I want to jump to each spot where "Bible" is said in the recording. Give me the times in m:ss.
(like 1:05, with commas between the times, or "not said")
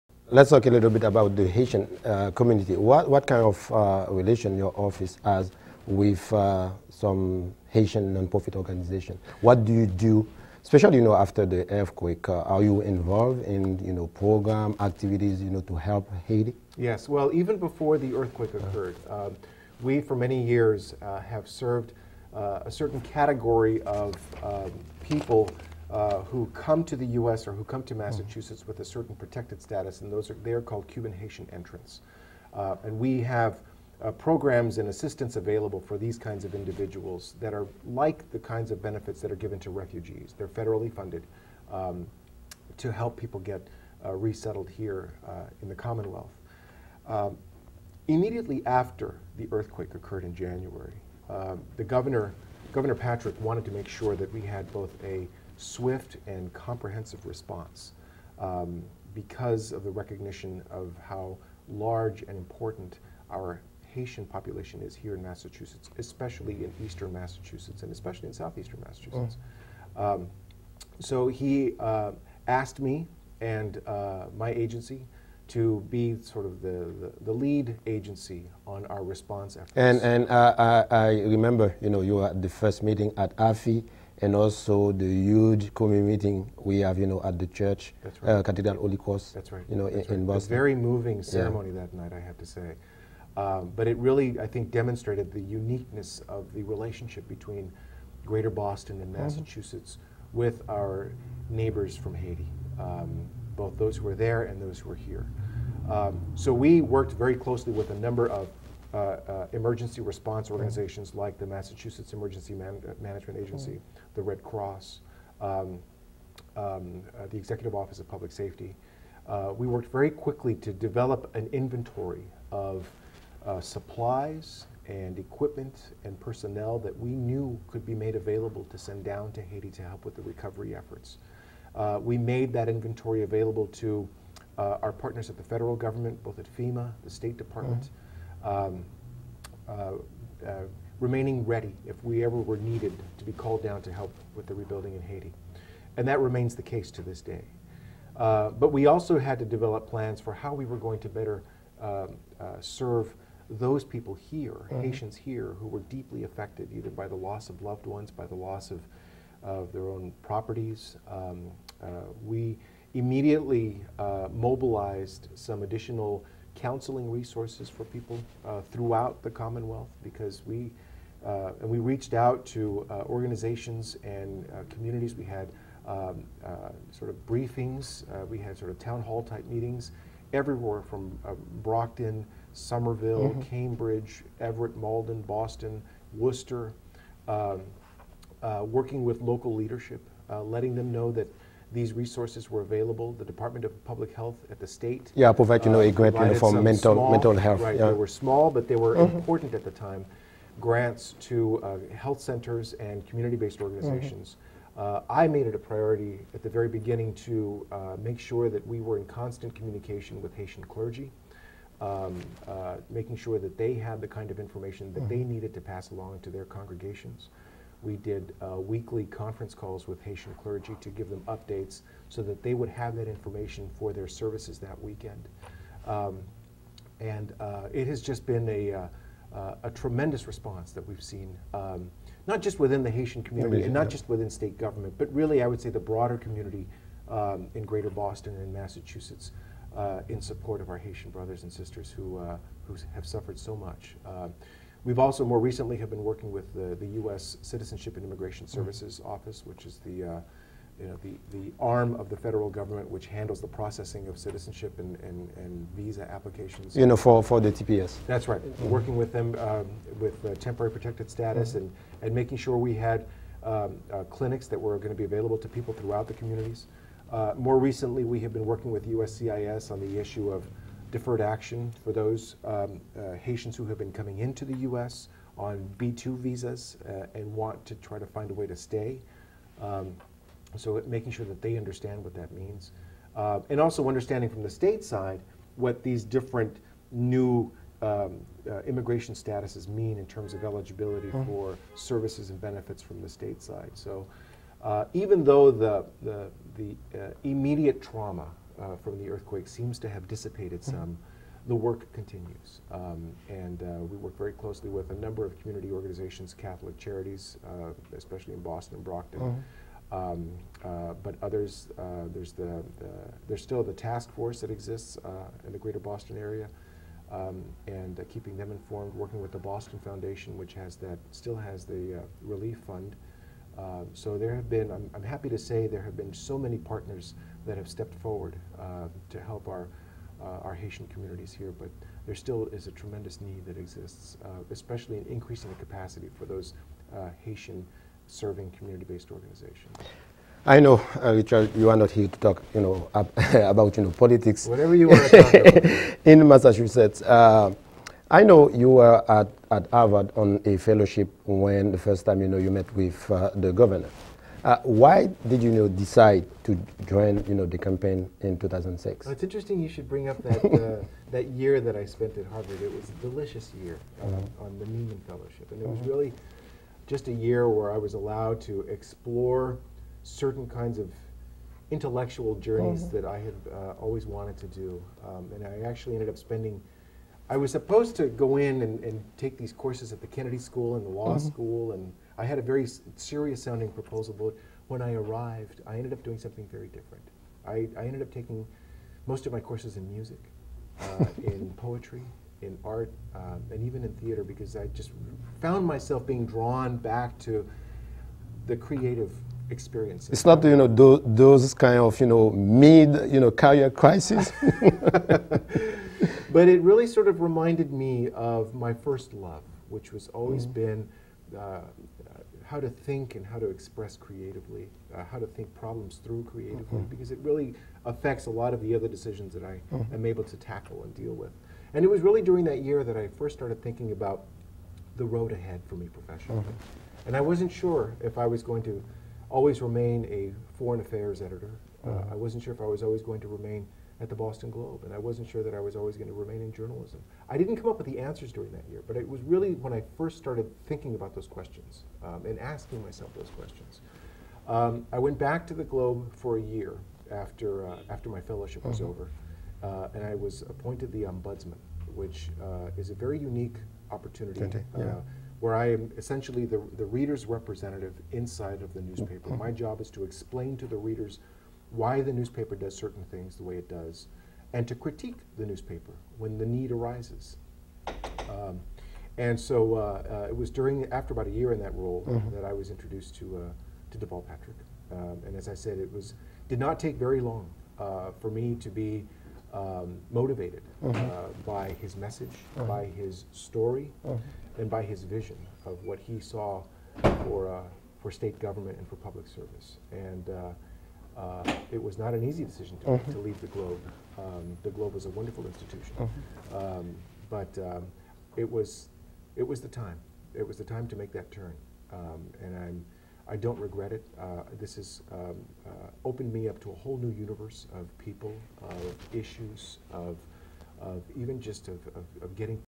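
not said.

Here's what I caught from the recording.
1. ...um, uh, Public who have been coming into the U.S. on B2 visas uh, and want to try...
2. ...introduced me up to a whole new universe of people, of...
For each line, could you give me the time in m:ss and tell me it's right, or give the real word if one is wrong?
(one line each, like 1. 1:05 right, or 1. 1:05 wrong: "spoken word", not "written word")
1. 4:32 wrong: "Haitians", not "Public"
2. 8:26 wrong: "opened", not "introduced".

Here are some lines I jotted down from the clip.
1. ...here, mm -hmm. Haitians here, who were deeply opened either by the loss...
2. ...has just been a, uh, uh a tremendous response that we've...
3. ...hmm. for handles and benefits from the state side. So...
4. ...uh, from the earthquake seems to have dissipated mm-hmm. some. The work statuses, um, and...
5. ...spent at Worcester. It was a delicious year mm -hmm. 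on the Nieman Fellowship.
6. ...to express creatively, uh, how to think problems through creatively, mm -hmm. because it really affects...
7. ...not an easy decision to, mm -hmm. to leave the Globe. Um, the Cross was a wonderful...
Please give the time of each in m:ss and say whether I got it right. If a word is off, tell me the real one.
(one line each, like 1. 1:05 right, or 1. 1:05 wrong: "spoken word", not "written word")
1. 2:34 wrong: "affected", not "opened"
2. 3:47 right
3. 4:51 wrong: "services", not "handles"
4. 4:58 wrong: "continues", not "statuses"
5. 6:01 wrong: "Harvard", not "Worcester"
6. 6:53 right
7. 8:11 wrong: "Globe", not "Cross".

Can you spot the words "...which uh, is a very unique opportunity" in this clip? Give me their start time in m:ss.
7:31.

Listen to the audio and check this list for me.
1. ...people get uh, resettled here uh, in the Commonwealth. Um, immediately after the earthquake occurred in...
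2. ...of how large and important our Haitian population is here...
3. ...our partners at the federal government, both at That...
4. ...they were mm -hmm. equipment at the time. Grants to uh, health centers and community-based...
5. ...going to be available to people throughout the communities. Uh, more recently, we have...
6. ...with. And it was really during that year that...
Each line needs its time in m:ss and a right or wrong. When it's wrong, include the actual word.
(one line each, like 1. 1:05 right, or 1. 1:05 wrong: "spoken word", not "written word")
1. 0:43 right
2. 1:00 right
3. 2:14 wrong: "FEMA", not "That"
4. 3:18 wrong: "important", not "equipment"
5. 4:24 right
6. 7:01 right.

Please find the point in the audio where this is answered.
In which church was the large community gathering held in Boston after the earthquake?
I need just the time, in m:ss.
1:28.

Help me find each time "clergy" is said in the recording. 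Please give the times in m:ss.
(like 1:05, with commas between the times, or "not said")
3:30, 3:40.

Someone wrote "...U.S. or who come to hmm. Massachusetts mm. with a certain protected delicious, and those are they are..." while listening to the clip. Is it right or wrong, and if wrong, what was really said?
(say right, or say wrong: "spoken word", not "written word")
wrong: "status", not "delicious".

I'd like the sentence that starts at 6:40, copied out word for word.
It's not you know those, those kind of you know mid you know career crisis.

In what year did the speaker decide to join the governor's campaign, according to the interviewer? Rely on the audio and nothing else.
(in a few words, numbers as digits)
2006.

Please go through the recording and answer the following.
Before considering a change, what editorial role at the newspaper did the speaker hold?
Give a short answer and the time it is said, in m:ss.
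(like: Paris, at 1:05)
foreign affairs editor, at 7:10.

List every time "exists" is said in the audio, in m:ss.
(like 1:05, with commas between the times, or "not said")
5:14, 5:33.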